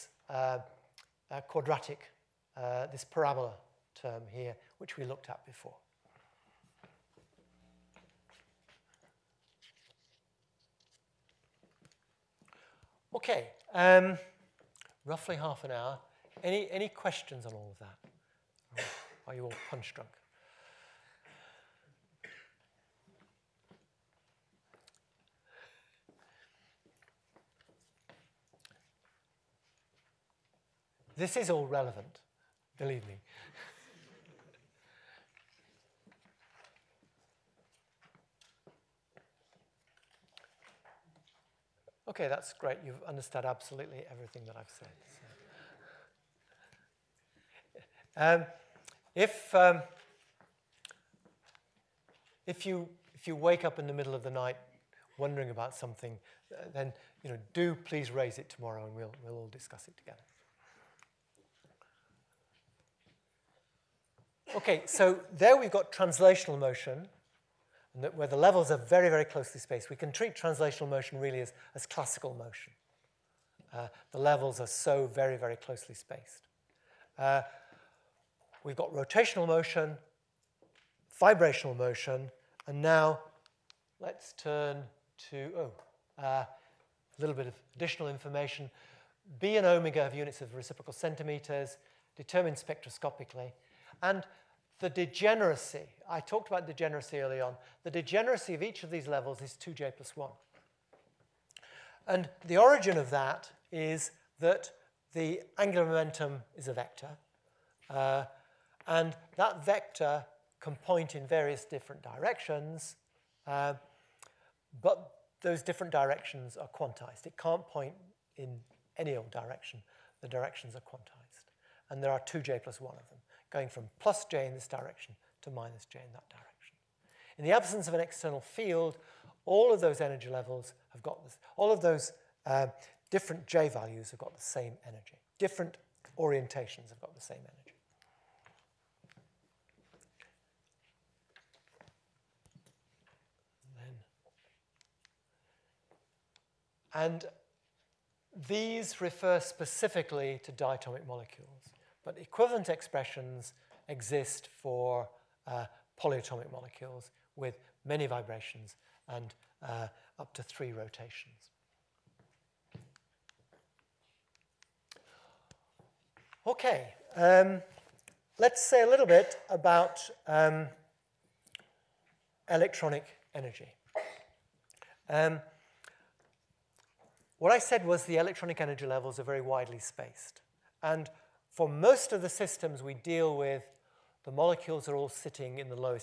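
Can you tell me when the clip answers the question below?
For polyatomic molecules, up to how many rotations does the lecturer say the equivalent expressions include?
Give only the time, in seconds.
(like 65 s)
160 s.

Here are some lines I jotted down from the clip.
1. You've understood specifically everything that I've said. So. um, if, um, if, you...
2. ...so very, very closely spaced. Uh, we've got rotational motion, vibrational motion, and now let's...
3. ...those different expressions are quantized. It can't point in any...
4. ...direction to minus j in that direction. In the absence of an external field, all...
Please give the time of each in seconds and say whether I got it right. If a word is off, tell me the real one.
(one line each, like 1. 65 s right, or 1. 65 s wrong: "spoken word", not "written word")
1. 42 s wrong: "absolutely", not "specifically"
2. 74 s right
3. 115 s wrong: "directions", not "expressions"
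4. 124 s right.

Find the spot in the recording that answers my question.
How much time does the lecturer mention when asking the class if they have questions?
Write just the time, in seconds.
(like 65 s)
15 s.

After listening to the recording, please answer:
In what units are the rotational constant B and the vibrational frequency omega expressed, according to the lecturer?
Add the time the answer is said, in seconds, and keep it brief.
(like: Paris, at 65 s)
reciprocal centimeters, at 90 s.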